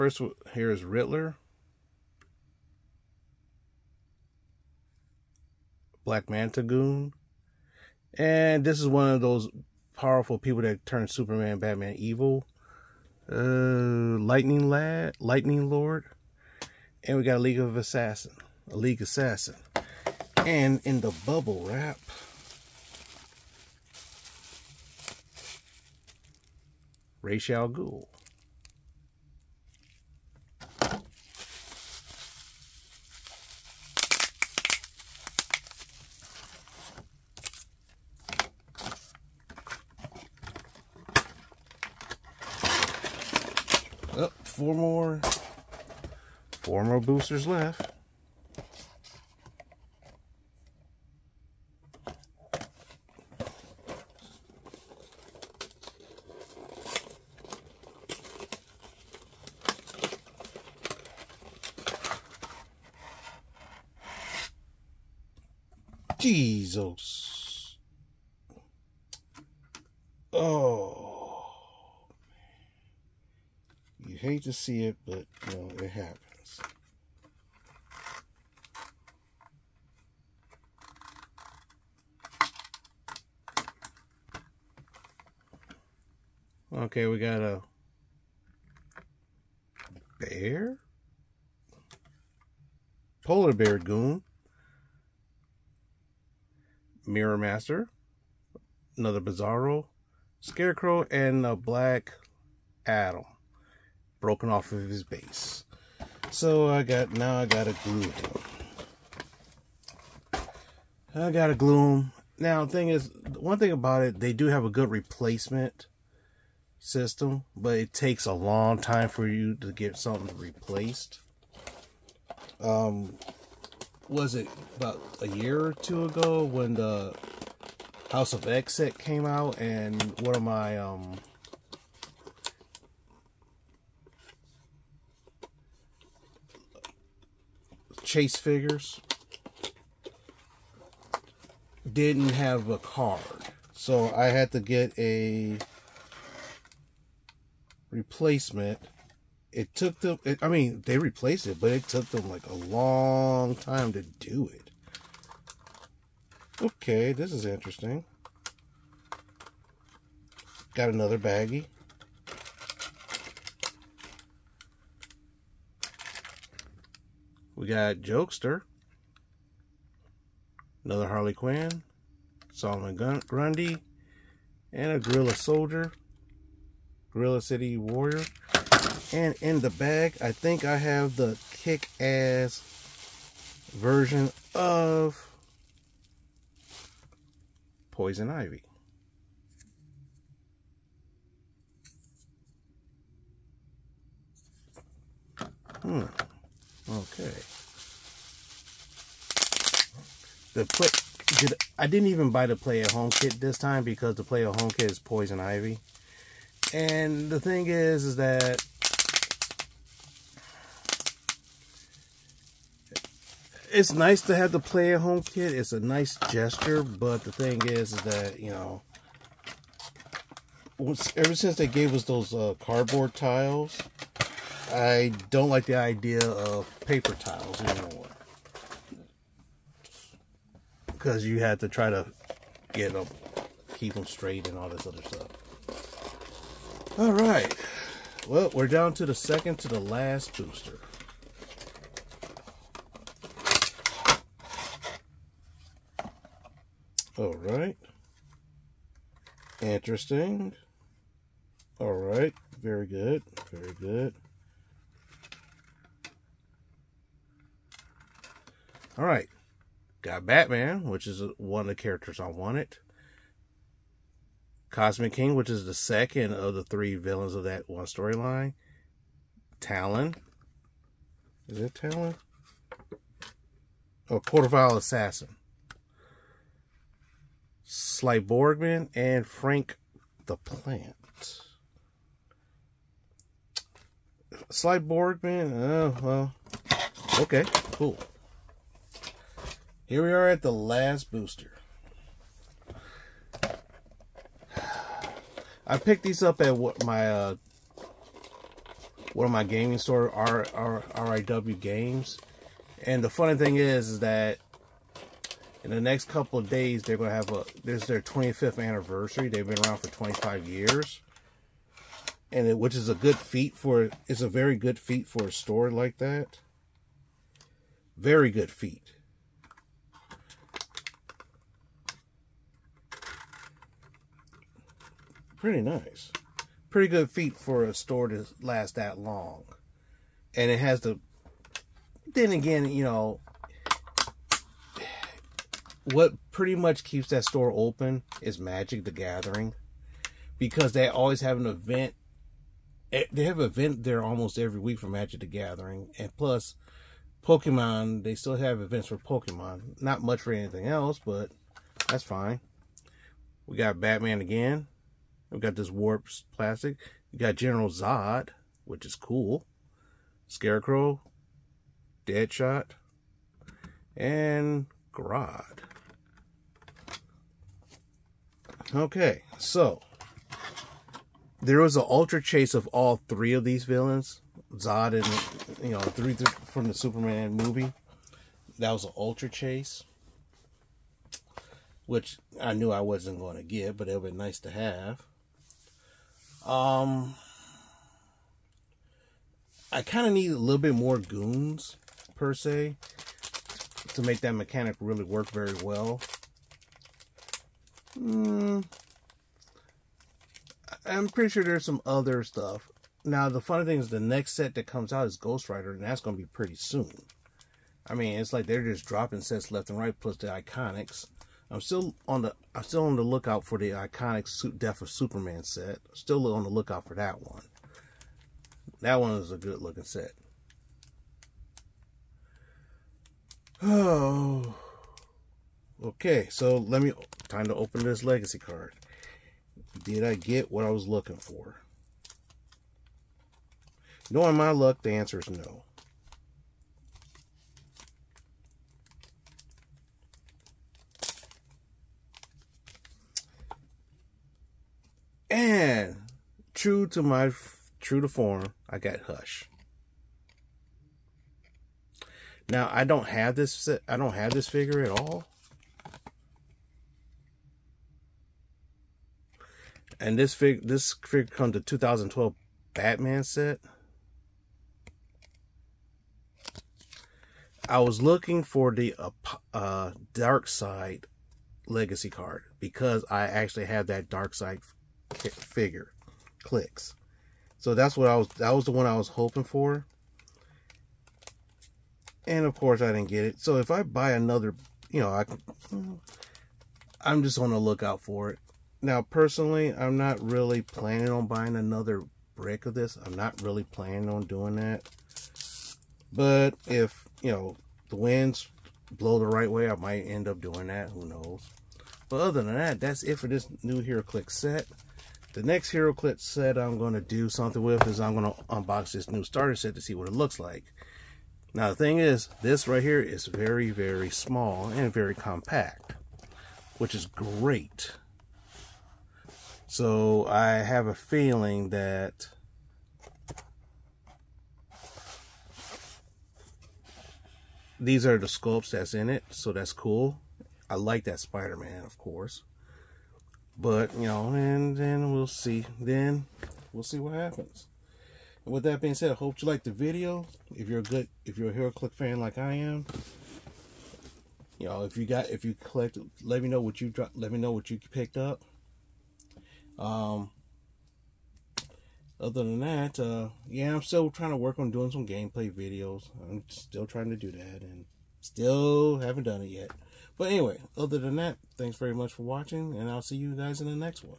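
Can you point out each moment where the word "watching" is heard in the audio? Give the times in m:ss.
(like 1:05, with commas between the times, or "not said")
9:22.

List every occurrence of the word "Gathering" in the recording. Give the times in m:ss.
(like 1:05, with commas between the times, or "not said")
5:38, 5:45.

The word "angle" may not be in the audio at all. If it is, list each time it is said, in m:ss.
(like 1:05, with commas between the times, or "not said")
not said.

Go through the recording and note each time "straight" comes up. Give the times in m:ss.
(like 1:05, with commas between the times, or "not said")
3:54.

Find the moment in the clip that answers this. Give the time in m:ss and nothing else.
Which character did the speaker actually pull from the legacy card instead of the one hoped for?
7:29.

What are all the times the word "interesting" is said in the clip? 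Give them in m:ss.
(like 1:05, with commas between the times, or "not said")
2:37, 4:09.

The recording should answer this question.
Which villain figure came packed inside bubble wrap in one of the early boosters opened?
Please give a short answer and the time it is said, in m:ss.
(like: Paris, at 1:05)
Ra's al Ghul, at 0:27.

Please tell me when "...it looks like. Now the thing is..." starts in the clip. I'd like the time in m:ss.
8:30.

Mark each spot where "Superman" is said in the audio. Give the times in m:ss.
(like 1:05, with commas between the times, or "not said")
0:11, 6:16, 6:54.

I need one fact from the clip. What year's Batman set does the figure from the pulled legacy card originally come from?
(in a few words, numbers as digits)
2012.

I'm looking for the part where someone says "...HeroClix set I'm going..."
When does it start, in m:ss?
8:25.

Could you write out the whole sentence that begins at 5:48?
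They still have events for Pokemon.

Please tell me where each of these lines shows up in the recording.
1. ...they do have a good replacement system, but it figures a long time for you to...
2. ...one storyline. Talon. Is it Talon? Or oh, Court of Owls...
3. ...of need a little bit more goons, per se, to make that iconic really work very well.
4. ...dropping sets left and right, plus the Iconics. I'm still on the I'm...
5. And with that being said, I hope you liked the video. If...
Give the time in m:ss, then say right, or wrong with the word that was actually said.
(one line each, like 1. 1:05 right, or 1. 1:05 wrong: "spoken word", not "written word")
1. 1:54 wrong: "takes", not "figures"
2. 4:27 right
3. 6:30 wrong: "mechanic", not "iconic"
4. 6:48 right
5. 8:58 right.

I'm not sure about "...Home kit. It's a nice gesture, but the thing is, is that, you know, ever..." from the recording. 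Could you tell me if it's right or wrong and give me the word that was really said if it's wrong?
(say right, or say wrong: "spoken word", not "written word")
right.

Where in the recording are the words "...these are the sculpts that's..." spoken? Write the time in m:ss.
8:47.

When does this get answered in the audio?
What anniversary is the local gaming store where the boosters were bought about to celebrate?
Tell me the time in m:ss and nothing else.
5:08.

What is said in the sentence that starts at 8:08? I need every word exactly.
Now, personally, I'm not really planning on buying another brick of this.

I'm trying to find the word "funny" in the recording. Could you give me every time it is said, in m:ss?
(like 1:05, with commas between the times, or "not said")
5:03, 6:43.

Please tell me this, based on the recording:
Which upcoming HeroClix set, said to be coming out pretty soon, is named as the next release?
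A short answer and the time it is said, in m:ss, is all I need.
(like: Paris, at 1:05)
Ghost Rider, at 6:45.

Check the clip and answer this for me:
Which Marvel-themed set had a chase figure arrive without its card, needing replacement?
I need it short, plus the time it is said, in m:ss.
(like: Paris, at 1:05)
House of X, at 2:08.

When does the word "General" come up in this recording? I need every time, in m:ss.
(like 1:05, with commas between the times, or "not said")
5:57.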